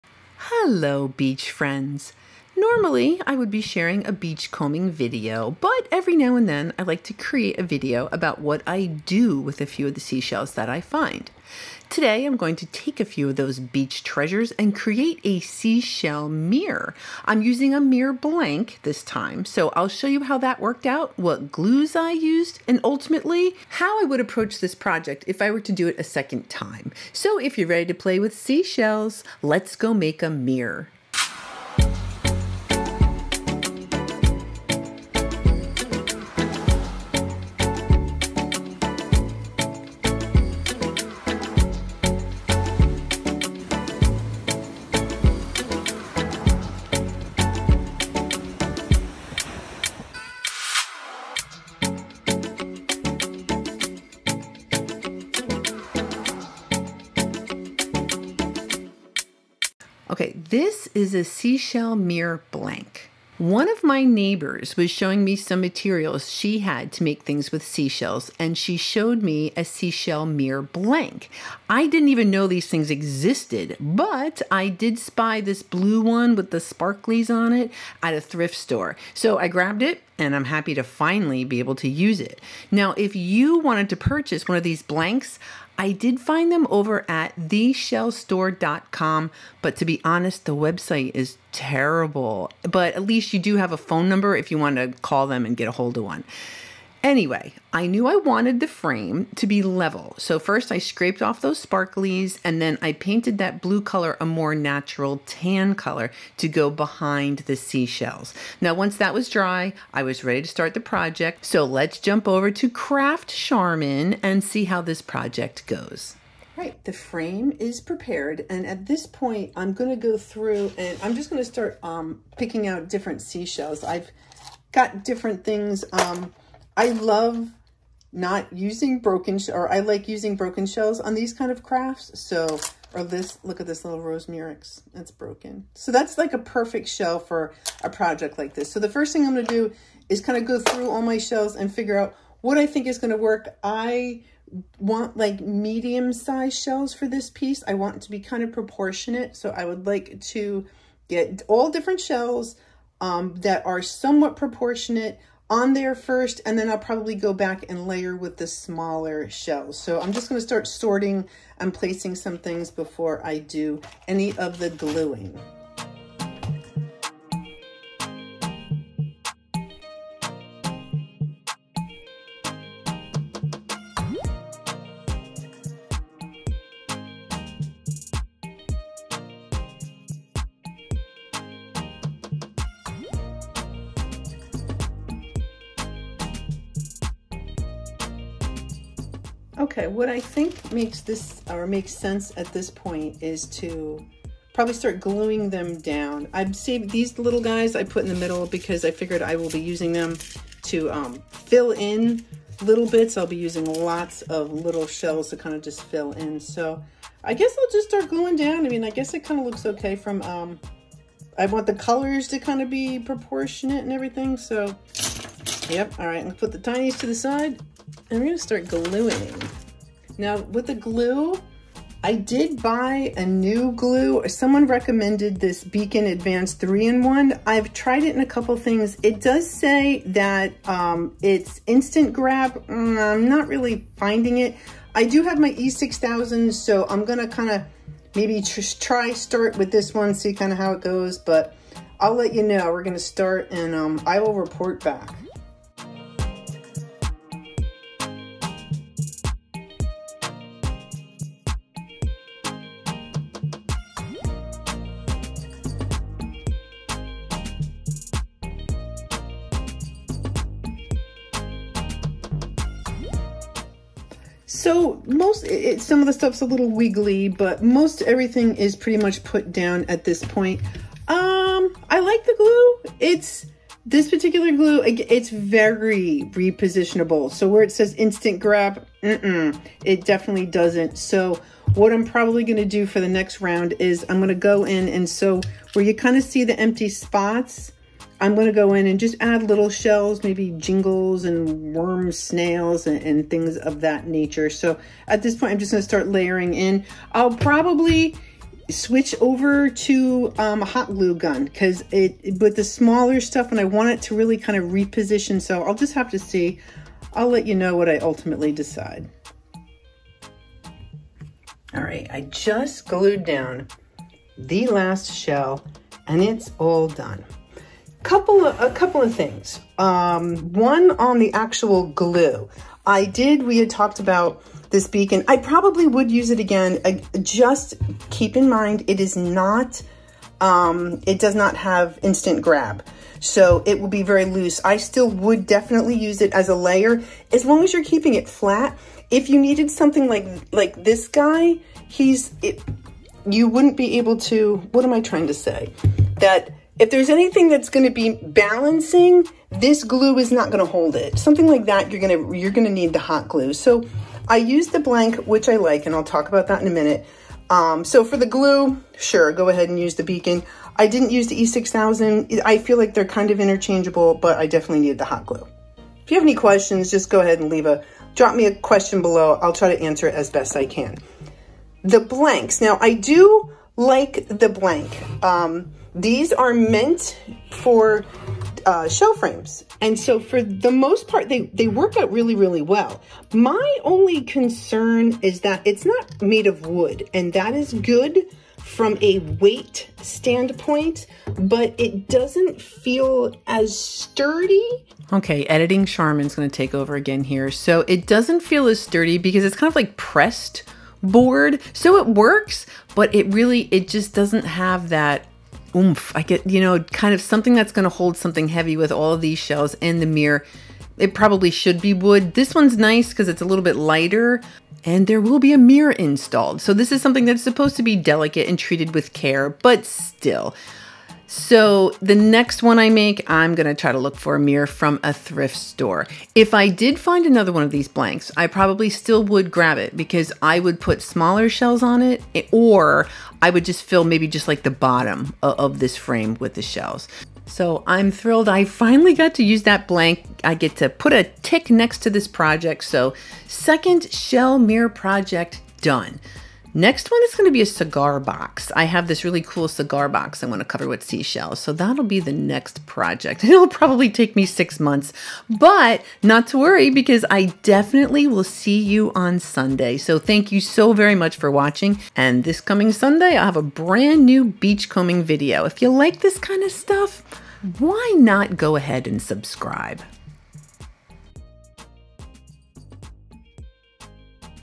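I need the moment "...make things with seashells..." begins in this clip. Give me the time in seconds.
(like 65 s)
67 s.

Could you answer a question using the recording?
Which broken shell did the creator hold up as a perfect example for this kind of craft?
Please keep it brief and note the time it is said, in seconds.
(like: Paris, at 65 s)
rose murex, at 134 s.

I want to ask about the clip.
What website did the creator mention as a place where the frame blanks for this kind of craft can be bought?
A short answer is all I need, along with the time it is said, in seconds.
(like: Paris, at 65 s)
theshellstore.com, at 87 s.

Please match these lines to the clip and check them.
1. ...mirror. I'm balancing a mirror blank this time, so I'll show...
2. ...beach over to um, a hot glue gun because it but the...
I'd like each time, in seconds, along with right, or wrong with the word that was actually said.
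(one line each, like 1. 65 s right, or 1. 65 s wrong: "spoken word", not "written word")
1. 16 s wrong: "using", not "balancing"
2. 298 s wrong: "switch", not "beach".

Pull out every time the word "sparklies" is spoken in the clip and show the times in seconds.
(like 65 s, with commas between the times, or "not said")
76 s, 101 s.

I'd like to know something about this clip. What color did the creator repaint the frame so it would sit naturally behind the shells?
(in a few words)
tan.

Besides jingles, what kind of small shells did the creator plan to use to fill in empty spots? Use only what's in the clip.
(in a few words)
worm snails.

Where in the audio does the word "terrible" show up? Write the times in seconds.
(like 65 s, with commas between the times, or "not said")
91 s.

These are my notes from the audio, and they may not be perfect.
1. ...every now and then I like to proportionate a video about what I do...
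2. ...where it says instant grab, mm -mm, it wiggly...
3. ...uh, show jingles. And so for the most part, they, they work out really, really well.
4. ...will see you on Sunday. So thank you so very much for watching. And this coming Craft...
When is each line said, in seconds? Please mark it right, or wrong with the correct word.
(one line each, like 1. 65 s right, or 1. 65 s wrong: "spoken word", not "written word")
1. 5 s wrong: "create", not "proportionate"
2. 277 s wrong: "definitely", not "wiggly"
3. 378 s wrong: "frames", not "jingles"
4. 458 s wrong: "Sunday", not "Craft".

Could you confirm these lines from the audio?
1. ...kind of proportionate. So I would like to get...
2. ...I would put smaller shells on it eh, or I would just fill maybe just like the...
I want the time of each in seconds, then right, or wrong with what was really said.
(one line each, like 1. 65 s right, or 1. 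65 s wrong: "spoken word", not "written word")
1. 148 s right
2. 430 s right.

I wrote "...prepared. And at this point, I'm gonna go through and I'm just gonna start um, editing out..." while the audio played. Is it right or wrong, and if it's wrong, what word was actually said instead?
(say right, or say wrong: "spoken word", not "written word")
wrong: "picking", not "editing".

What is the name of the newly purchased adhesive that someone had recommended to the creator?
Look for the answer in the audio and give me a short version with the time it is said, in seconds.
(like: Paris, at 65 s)
Beacon Advanced 3-in-1, at 225 s.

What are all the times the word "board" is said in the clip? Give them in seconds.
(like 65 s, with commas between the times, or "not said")
401 s.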